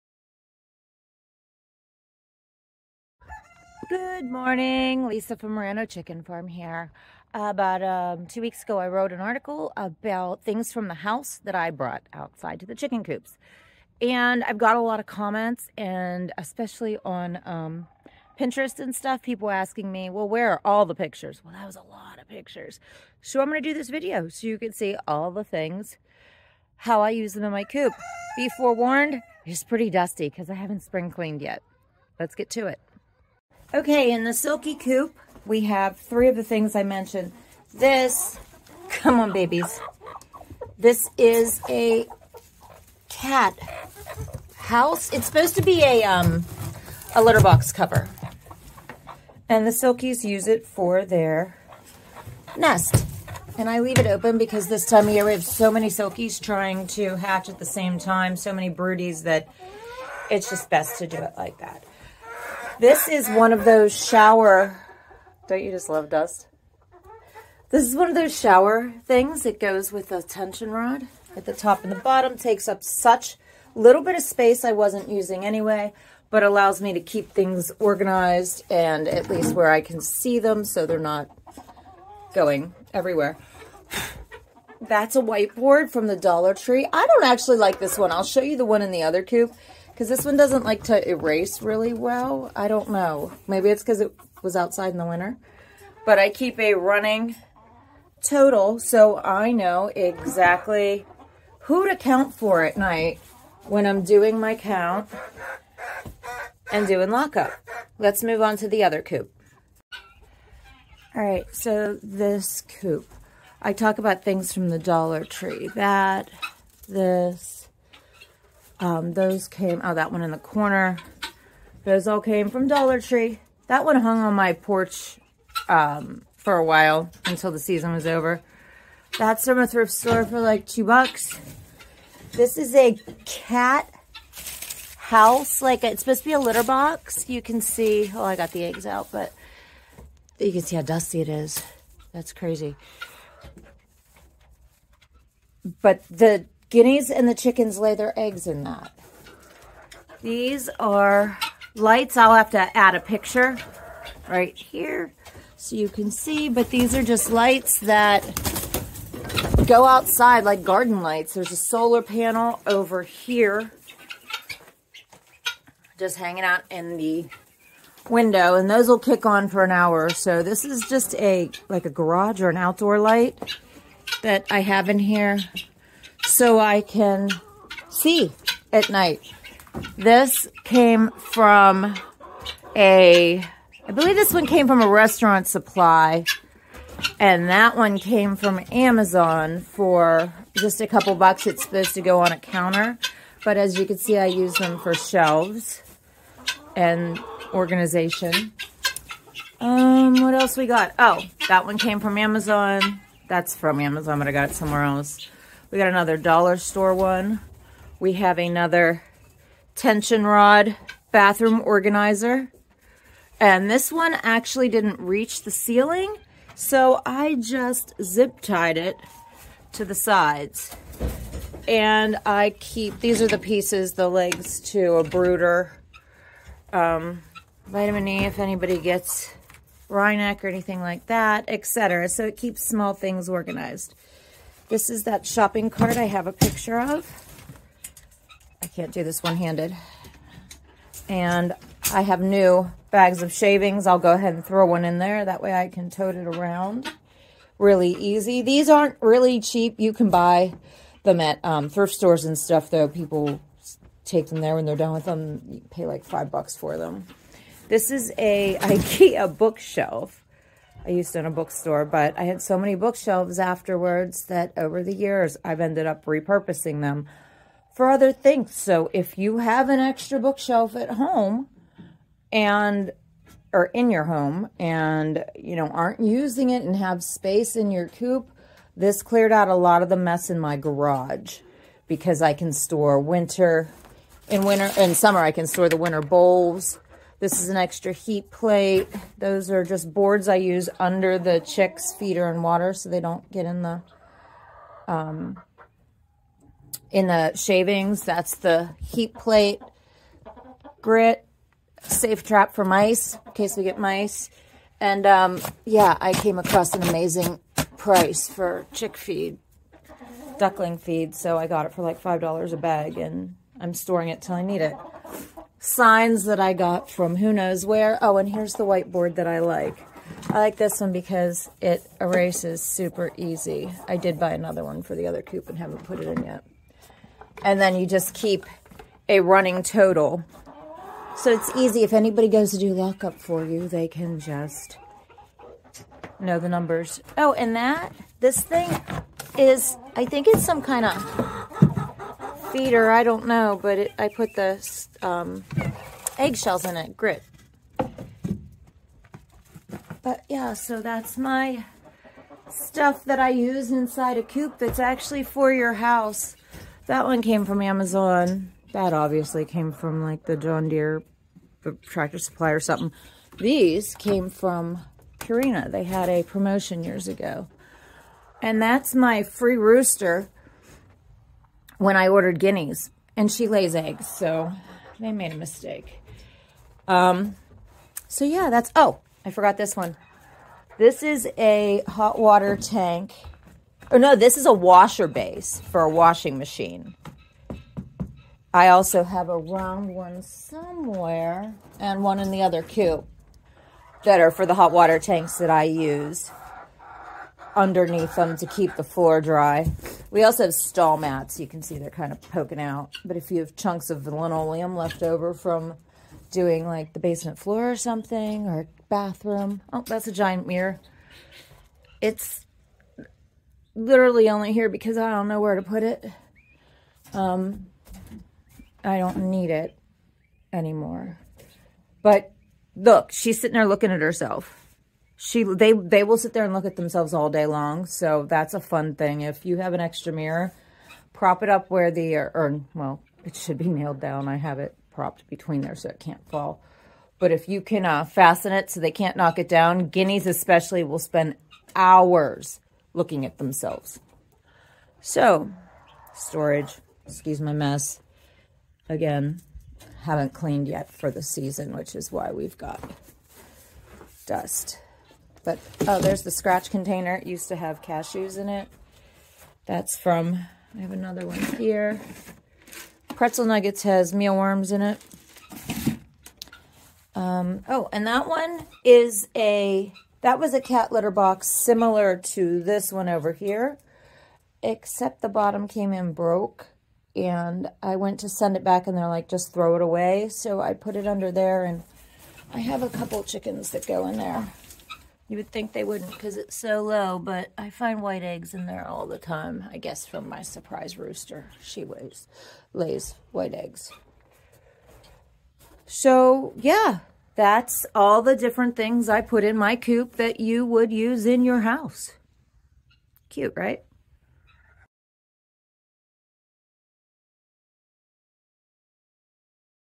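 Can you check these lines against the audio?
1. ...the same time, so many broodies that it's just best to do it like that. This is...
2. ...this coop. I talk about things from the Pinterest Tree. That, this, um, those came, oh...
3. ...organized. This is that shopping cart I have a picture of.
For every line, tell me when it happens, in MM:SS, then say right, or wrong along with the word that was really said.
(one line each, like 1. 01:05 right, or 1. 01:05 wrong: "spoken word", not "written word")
1. 00:57 right
2. 01:52 wrong: "Dollar", not "Pinterest"
3. 03:53 right.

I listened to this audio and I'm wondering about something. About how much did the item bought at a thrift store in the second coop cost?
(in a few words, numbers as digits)
2 bucks.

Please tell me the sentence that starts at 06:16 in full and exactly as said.
Um, so yeah, that's, oh, I forgot this one.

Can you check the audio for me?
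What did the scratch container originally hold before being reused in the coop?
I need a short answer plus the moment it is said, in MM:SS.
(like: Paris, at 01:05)
cashews, at 07:37.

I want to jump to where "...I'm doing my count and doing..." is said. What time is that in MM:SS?
01:43.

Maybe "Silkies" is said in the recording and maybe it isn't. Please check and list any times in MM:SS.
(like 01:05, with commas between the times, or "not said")
00:34, 00:49, 00:55.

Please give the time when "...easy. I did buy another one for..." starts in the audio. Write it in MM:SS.
05:23.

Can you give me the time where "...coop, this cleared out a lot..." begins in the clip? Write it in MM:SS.
04:37.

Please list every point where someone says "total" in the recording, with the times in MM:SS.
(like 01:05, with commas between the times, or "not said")
01:38, 05:29.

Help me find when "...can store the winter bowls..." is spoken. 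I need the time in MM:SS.
04:45.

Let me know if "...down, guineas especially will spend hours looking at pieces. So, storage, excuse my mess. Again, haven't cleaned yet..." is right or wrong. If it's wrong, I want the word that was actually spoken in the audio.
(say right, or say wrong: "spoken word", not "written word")
wrong: "themselves", not "pieces".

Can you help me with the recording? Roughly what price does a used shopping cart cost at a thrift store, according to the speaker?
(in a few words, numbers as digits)
5 bucks.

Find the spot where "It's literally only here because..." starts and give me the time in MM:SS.
06:52.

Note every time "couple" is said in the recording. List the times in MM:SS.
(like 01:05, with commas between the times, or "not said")
03:10, 08:02.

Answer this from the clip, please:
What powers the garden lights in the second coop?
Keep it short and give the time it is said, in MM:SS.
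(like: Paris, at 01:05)
solar panel, at 02:41.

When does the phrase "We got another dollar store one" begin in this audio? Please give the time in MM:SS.
03:25.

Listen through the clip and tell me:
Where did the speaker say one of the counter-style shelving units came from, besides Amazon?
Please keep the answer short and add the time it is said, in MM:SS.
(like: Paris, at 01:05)
restaurant supply, at 03:04.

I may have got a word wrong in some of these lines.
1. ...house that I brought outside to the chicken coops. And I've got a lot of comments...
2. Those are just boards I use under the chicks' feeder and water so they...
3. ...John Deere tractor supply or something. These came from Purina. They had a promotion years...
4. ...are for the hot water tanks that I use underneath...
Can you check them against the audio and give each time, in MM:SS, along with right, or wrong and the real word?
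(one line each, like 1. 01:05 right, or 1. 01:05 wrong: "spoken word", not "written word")
1. 00:10 right
2. 04:49 right
3. 06:00 right
4. 06:34 right.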